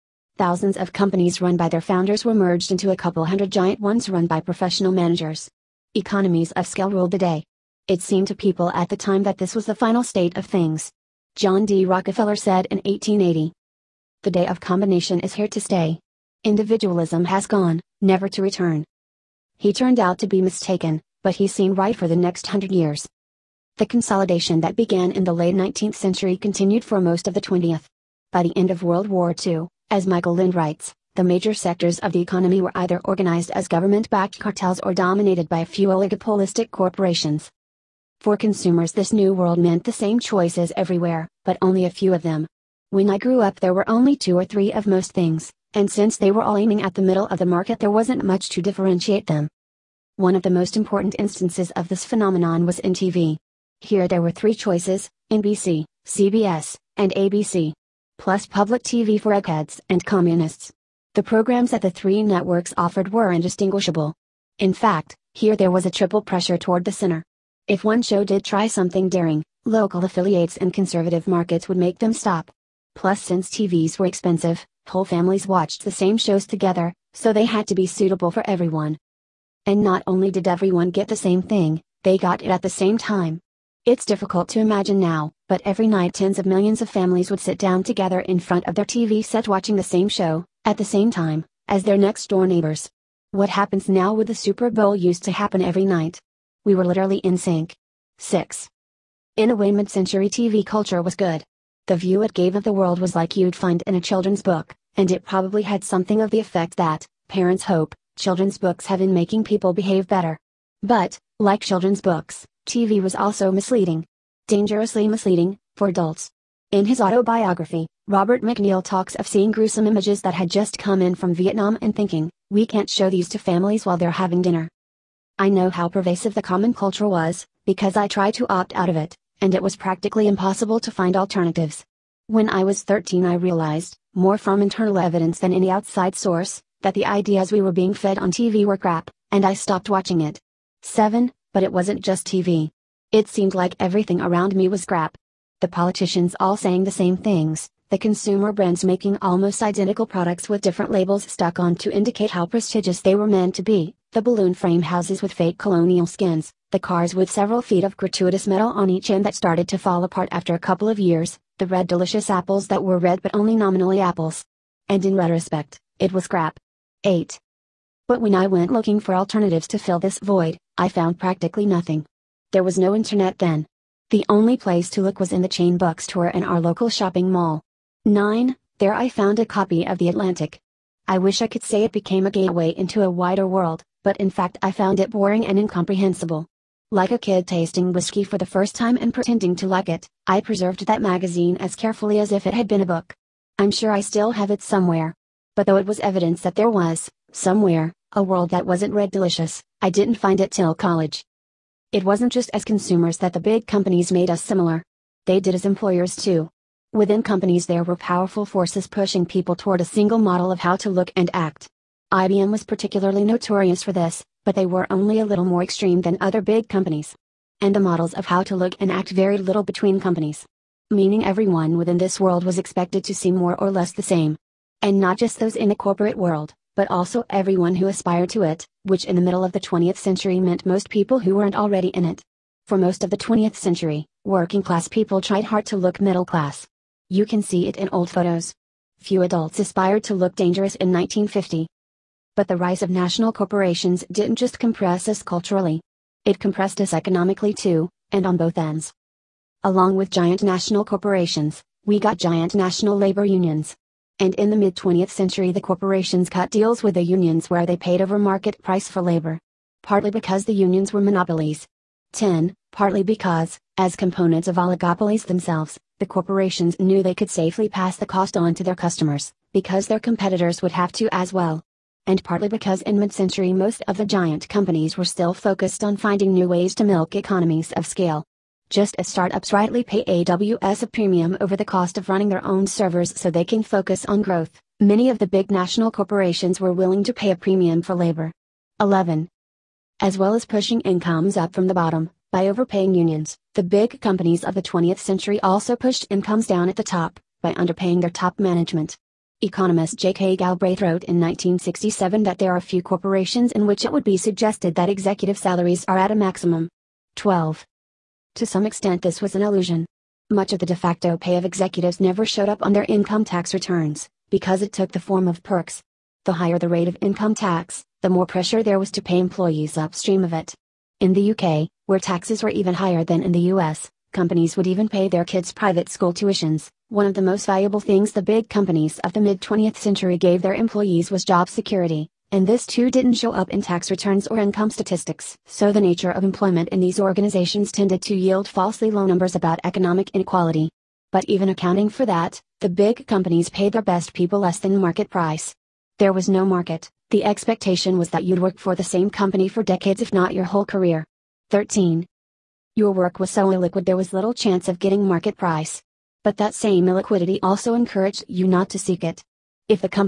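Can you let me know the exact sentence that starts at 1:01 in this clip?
The programs that the three networks offered were indistinguishable.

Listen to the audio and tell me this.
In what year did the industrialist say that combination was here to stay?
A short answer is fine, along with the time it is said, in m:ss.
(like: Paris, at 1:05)
1880, at 0:12.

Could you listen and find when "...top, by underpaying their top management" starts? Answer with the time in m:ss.
4:56.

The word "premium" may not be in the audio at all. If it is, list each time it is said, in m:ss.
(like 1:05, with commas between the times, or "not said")
4:40, 4:47.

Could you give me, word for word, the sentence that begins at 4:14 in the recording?
And in the mid 20th century, the corporations cut deals with the unions where they paid over market price for labor.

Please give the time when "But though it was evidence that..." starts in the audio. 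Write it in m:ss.
3:15.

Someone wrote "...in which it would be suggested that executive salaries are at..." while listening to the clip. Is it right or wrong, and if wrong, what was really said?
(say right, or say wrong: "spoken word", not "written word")
right.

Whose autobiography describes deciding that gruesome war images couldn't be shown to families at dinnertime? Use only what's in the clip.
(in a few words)
Robert MacNeil.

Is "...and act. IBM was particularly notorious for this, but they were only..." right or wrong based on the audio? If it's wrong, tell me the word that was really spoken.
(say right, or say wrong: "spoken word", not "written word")
right.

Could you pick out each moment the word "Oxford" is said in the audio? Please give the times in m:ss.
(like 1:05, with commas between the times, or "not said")
not said.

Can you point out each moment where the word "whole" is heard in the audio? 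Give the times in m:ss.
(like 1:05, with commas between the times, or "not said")
1:14, 5:50.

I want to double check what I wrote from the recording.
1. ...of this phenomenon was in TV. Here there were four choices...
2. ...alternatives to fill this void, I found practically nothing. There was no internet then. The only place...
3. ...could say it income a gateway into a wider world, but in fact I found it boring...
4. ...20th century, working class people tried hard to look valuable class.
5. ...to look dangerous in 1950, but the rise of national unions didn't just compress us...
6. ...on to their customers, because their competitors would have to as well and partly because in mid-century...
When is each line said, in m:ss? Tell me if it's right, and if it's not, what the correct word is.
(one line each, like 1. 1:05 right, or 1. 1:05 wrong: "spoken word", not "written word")
1. 0:51 wrong: "three", not "four"
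2. 2:49 right
3. 3:01 wrong: "became", not "income"
4. 3:53 wrong: "middle", not "valuable"
5. 4:00 wrong: "corporations", not "unions"
6. 4:28 right.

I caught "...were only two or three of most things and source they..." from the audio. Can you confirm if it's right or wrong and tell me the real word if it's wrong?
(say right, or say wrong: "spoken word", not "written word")
wrong: "since", not "source".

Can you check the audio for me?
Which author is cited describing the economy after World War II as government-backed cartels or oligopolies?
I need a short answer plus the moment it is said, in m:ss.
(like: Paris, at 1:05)
Michael Lind, at 0:30.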